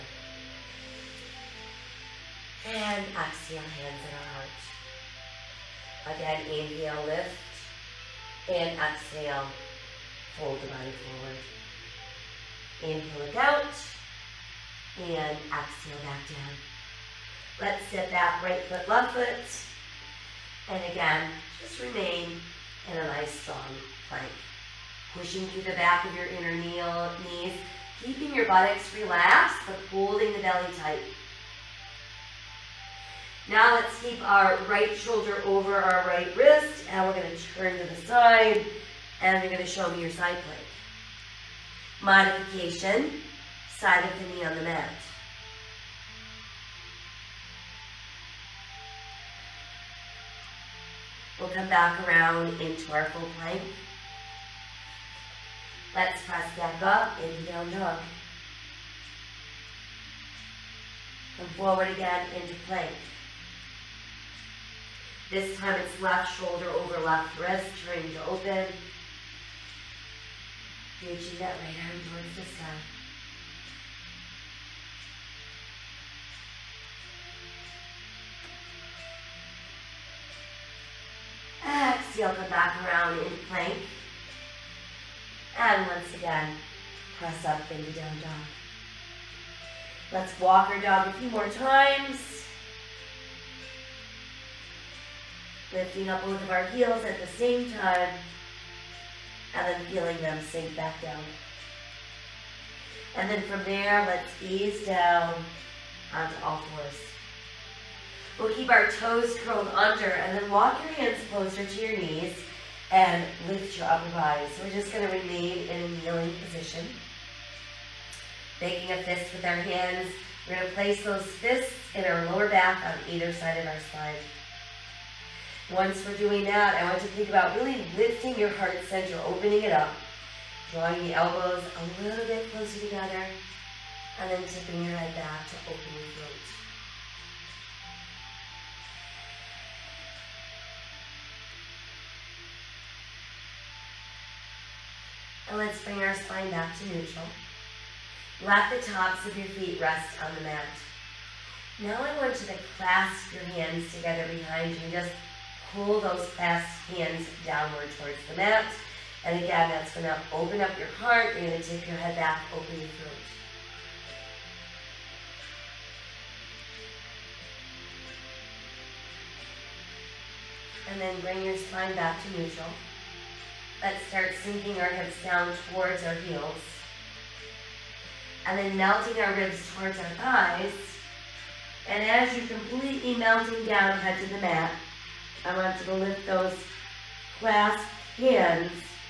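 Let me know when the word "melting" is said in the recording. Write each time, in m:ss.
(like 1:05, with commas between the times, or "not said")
2:58, 3:03.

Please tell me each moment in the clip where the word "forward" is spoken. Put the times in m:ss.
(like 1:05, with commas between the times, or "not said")
0:12, 1:01.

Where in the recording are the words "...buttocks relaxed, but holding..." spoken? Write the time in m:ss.
0:28.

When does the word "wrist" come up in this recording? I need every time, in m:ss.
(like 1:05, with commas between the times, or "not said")
0:36, 1:07.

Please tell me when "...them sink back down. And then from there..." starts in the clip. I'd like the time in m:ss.
1:40.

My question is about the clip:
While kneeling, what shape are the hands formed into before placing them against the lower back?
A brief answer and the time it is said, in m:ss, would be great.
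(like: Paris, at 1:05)
A fist, at 1:59.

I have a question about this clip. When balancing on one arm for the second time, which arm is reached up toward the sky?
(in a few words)
Right arm.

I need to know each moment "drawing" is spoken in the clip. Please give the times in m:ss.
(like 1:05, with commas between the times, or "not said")
2:10.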